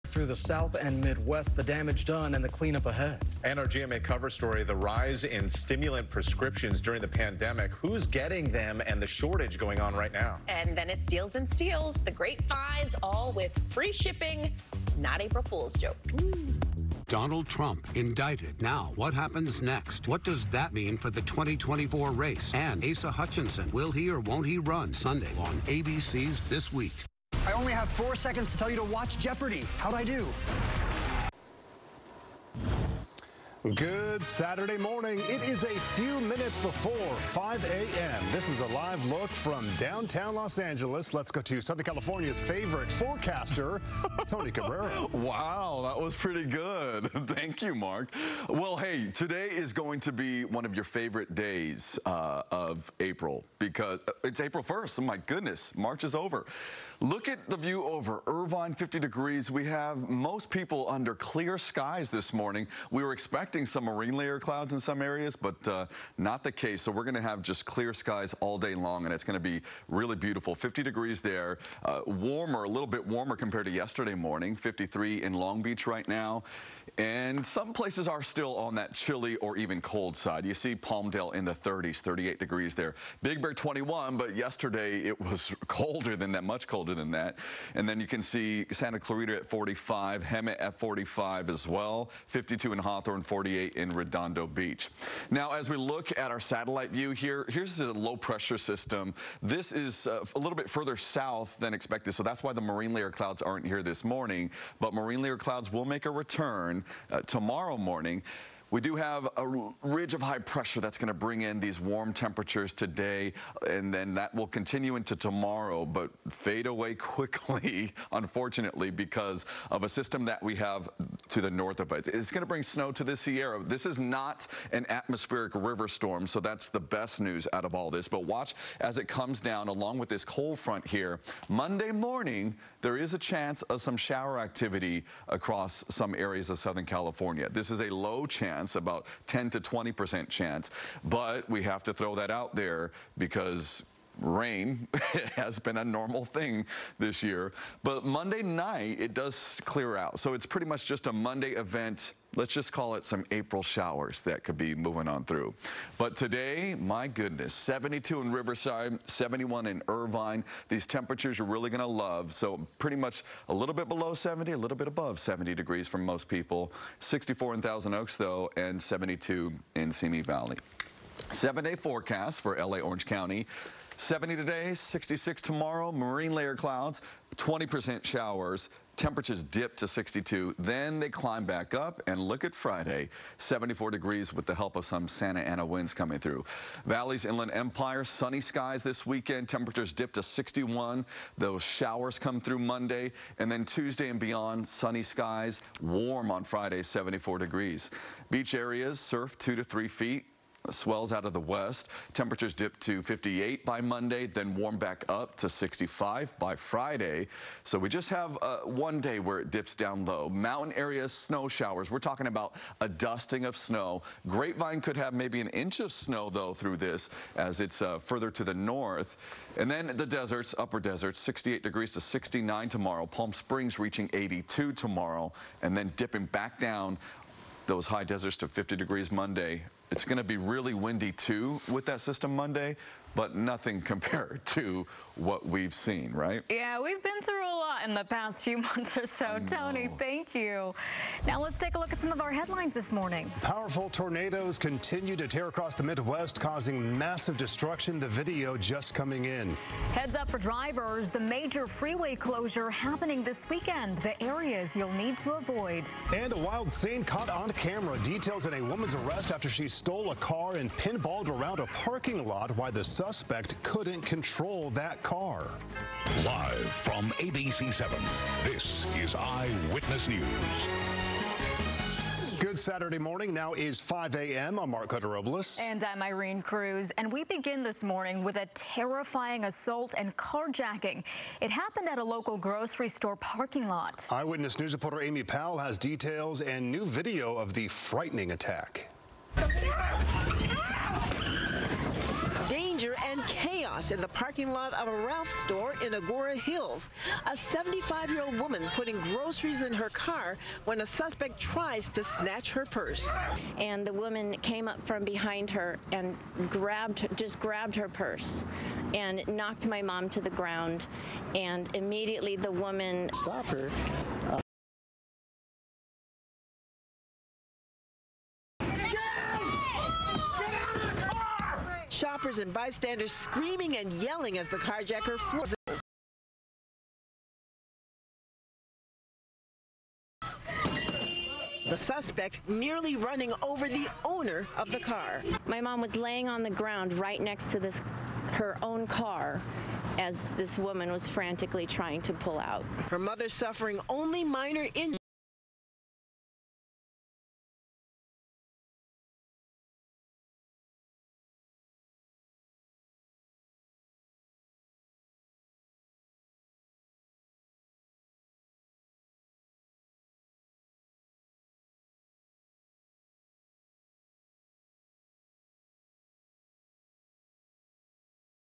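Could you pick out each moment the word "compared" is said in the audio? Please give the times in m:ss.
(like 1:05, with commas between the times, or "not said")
1:13, 3:53.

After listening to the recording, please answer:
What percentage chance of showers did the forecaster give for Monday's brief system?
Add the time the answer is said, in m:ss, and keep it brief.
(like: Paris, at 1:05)
10 to 20%, at 2:19.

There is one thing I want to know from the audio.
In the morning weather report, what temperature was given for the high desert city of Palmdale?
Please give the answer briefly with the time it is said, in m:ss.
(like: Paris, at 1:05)
38 degrees, at 1:22.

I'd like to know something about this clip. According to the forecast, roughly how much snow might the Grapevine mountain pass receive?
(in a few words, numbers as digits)
an inch.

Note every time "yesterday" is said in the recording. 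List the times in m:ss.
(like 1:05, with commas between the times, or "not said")
1:13, 1:24.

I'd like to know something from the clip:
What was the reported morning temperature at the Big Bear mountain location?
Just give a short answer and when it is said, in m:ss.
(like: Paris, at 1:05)
21, at 1:23.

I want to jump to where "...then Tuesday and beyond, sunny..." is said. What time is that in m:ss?
3:13.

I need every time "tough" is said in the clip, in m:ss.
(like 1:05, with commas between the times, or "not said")
not said.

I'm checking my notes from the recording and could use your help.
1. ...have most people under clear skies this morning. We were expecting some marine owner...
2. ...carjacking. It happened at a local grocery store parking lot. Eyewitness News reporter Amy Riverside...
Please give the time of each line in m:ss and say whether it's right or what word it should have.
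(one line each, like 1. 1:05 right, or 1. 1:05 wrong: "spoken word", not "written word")
1. 0:59 wrong: "layer", not "owner"
2. 4:40 wrong: "Powell", not "Riverside".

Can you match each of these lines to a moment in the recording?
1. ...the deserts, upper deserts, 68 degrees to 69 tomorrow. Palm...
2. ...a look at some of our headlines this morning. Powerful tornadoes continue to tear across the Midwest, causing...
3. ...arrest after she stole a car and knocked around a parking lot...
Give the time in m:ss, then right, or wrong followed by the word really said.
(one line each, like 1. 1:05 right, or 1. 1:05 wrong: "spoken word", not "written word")
1. 3:39 right
2. 4:01 right
3. 4:18 wrong: "pinballed", not "knocked".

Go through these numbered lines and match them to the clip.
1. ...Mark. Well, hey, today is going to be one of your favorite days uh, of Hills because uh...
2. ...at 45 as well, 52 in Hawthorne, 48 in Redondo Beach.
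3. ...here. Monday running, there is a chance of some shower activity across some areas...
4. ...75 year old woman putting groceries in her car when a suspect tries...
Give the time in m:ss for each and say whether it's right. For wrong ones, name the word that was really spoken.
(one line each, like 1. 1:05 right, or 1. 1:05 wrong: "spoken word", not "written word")
1. 0:47 wrong: "April", not "Hills"
2. 1:30 right
3. 2:10 wrong: "morning", not "running"
4. 4:57 right.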